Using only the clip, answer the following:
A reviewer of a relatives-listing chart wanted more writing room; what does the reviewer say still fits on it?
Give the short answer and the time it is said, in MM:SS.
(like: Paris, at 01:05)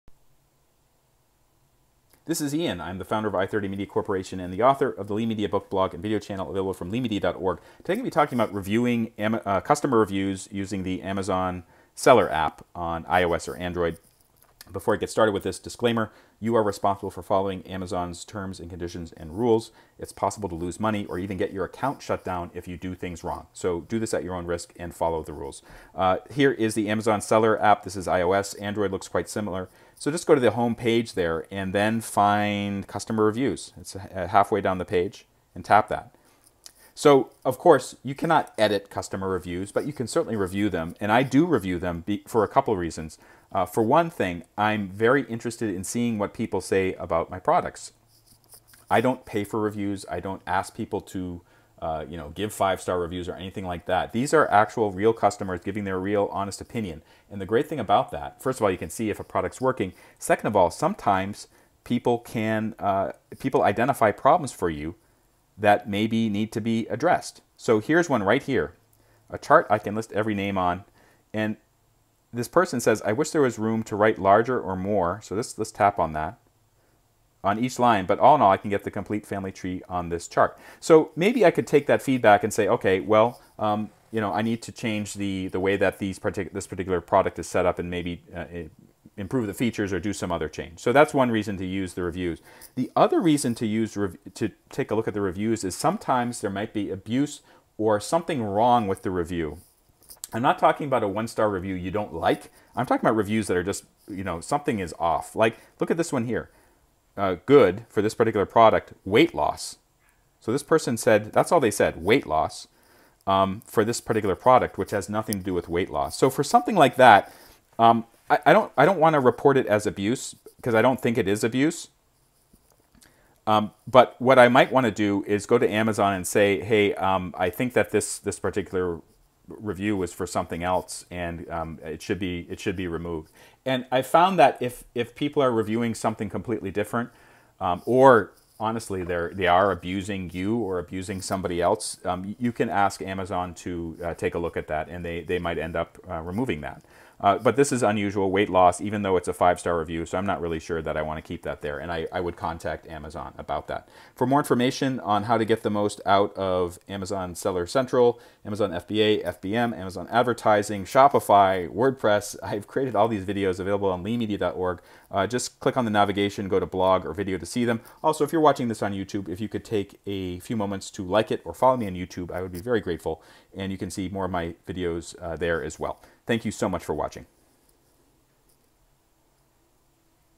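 complete family tree, at 01:18.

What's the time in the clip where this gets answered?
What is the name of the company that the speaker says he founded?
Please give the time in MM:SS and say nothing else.
00:03.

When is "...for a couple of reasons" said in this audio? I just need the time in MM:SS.
00:42.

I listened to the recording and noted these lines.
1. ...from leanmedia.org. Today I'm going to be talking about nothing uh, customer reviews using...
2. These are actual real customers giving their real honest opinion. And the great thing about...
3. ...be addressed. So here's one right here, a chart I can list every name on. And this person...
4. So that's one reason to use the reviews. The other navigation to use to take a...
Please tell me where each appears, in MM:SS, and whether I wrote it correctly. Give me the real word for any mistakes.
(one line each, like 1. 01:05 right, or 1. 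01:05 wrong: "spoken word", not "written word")
1. 00:06 wrong: "reviewing", not "nothing"
2. 00:54 right
3. 01:06 right
4. 01:30 wrong: "reason", not "navigation".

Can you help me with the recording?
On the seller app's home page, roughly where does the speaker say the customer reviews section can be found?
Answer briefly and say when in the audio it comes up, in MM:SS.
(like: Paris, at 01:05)
halfway down the page, at 00:34.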